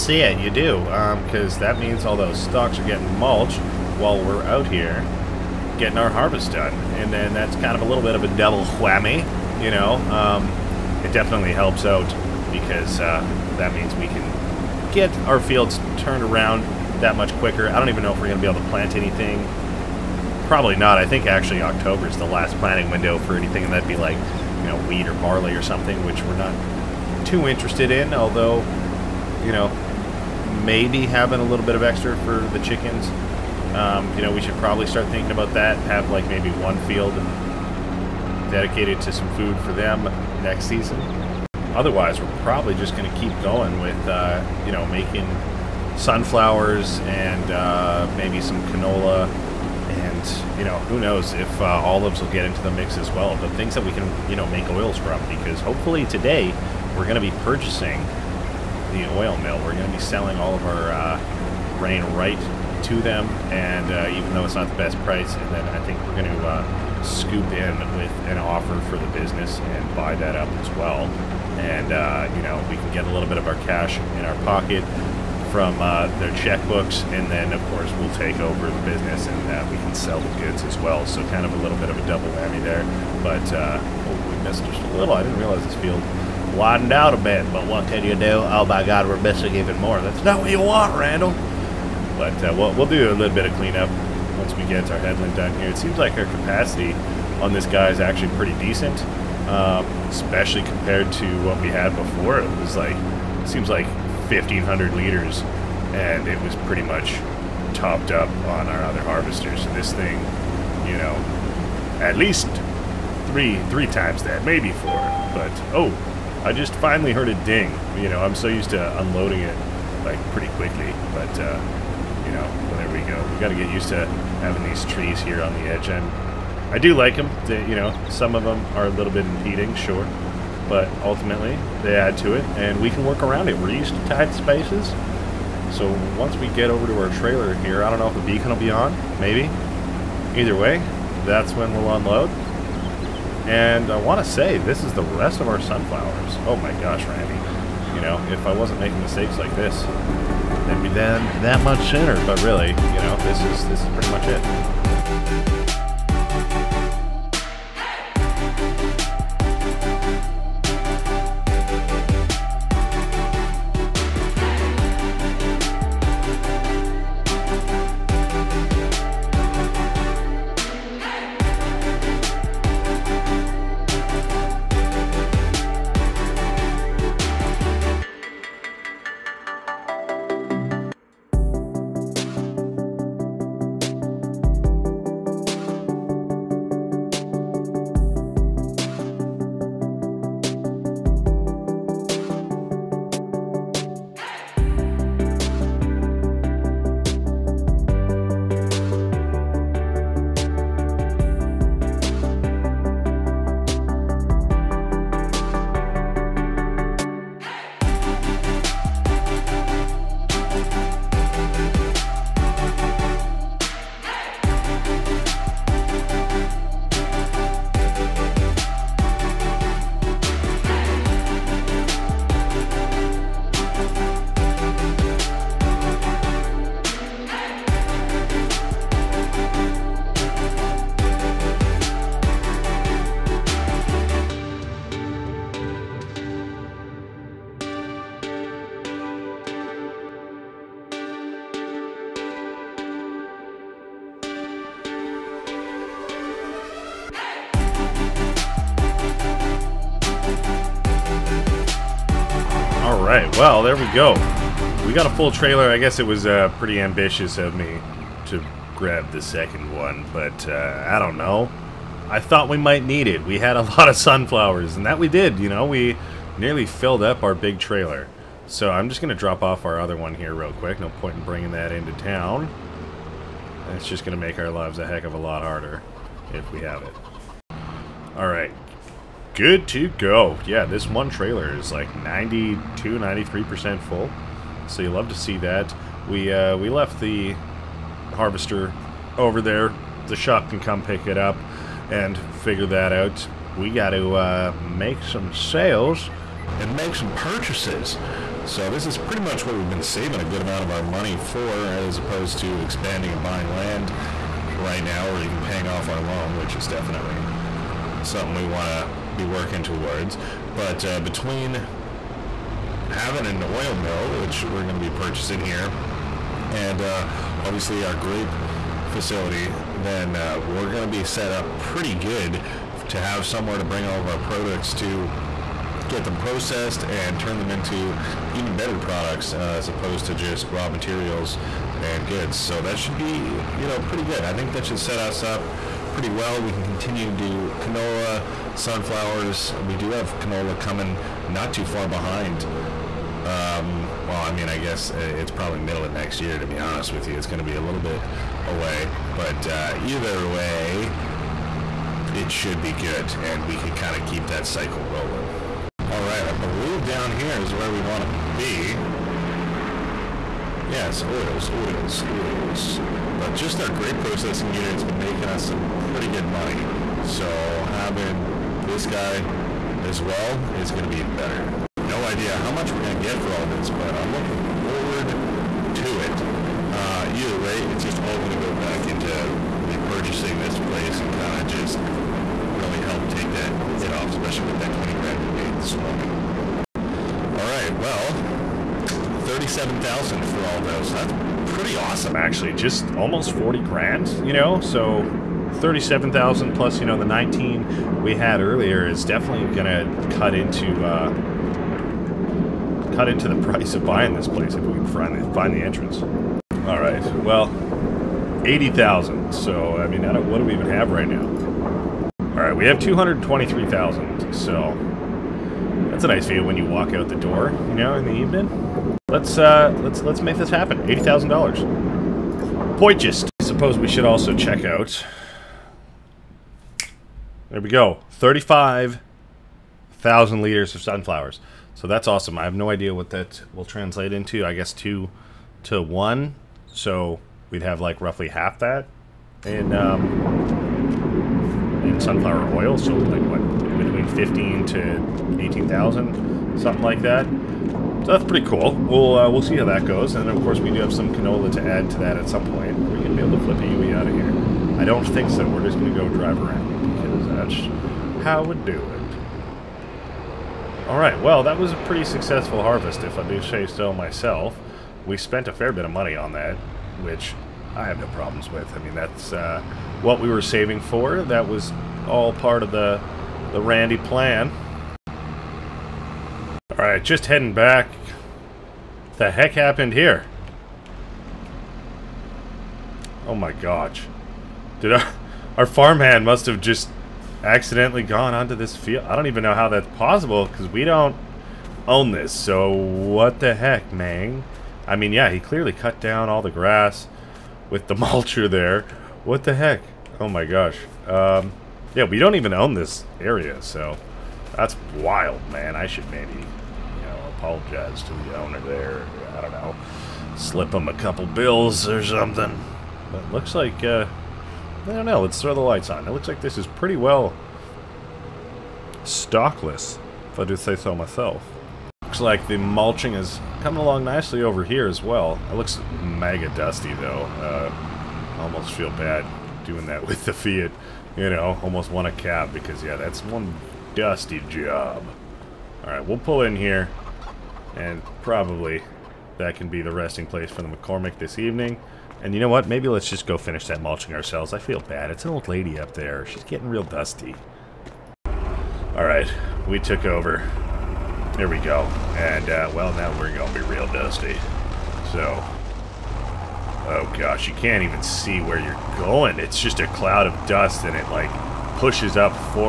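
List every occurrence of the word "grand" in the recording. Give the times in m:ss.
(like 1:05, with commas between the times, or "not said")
6:24, 6:33.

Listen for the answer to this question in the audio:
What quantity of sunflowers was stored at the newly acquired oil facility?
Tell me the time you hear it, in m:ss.
7:08.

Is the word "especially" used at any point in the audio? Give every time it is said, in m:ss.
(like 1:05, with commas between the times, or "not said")
1:40, 6:24.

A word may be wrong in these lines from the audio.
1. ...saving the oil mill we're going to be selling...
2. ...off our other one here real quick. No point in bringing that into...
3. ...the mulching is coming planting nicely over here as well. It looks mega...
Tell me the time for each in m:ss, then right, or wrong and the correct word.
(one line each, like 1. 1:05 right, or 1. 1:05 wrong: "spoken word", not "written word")
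1. 0:57 wrong: "purchasing", not "saving"
2. 4:29 right
3. 8:42 wrong: "along", not "planting".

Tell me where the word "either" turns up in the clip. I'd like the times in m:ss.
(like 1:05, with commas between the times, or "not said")
2:20, 5:49, 6:17.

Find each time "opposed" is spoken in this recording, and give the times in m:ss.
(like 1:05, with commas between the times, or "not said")
5:01, 5:29.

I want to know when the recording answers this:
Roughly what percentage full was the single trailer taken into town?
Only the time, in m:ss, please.
4:42.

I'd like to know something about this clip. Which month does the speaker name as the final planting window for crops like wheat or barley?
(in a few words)
October.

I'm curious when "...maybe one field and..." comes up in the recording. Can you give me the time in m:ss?
0:36.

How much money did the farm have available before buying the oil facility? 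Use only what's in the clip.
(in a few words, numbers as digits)
223,000.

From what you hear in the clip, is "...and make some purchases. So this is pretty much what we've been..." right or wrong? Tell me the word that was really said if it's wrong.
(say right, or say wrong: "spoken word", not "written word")
right.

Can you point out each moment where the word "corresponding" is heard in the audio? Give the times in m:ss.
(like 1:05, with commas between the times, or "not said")
not said.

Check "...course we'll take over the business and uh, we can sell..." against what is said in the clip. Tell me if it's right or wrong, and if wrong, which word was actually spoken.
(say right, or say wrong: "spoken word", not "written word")
right.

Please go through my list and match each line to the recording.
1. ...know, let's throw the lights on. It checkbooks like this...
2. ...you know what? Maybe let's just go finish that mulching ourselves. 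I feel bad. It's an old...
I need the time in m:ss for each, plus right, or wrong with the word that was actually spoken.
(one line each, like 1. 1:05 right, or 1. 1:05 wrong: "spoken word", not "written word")
1. 8:35 wrong: "looks", not "checkbooks"
2. 9:02 right.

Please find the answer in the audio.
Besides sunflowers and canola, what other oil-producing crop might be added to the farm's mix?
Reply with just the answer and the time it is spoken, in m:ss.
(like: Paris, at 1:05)
olives, at 0:51.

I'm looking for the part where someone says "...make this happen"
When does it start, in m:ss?
7:00.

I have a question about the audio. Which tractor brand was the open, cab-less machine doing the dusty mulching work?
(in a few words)
Fiat.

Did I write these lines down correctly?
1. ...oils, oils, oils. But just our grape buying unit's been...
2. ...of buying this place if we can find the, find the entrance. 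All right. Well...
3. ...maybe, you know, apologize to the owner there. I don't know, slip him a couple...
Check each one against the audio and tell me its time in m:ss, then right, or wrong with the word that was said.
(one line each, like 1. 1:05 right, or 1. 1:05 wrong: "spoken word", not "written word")
1. 6:01 wrong: "processing", not "buying"
2. 6:43 right
3. 8:26 right.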